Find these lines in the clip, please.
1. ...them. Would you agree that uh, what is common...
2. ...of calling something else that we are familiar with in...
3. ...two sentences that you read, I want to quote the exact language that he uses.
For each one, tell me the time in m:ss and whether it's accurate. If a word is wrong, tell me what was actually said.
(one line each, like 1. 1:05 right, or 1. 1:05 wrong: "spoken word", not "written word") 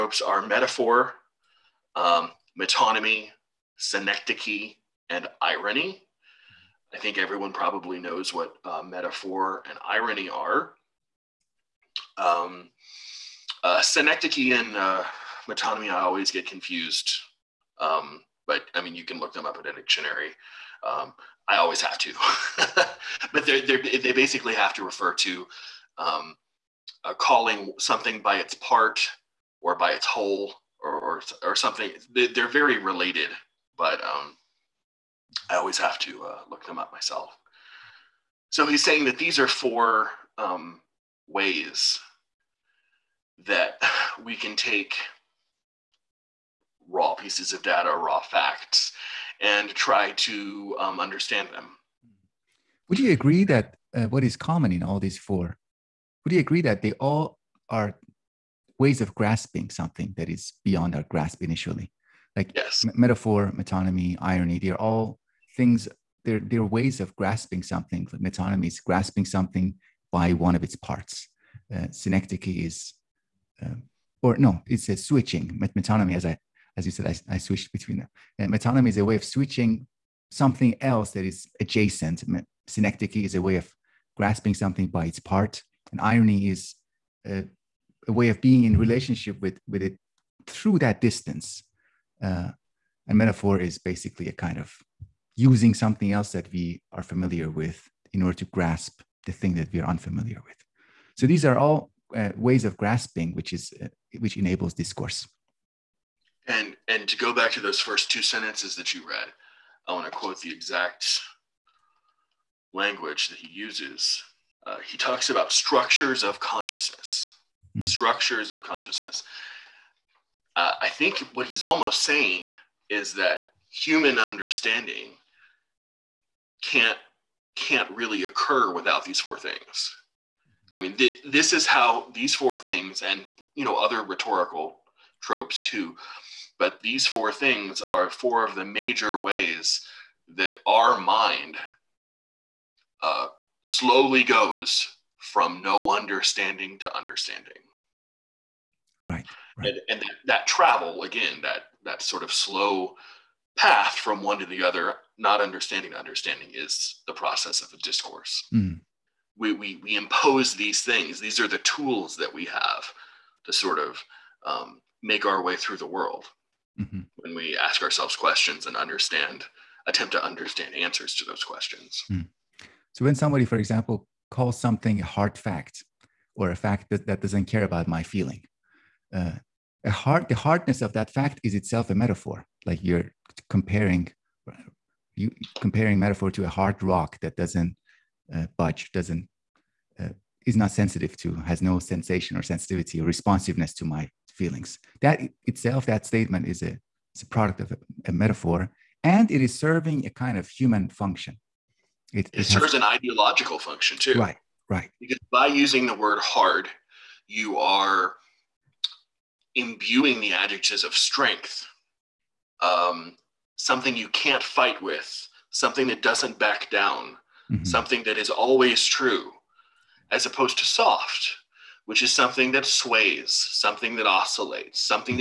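1. 0:51 right
2. 1:34 wrong: "using", not "calling"
3. 1:48 right.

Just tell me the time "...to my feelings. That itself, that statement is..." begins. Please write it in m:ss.
3:13.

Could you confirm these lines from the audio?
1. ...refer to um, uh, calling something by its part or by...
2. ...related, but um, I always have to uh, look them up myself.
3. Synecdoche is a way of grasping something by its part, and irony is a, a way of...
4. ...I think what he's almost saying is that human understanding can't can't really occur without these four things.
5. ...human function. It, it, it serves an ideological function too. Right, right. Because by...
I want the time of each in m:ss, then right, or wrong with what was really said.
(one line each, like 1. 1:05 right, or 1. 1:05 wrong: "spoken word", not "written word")
1. 0:24 right
2. 0:32 right
3. 1:22 right
4. 2:00 right
5. 3:20 right.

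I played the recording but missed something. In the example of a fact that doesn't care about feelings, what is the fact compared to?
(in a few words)
a hard rock.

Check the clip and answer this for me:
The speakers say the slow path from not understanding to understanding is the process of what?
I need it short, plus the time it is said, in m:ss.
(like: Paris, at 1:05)
a discourse, at 2:37.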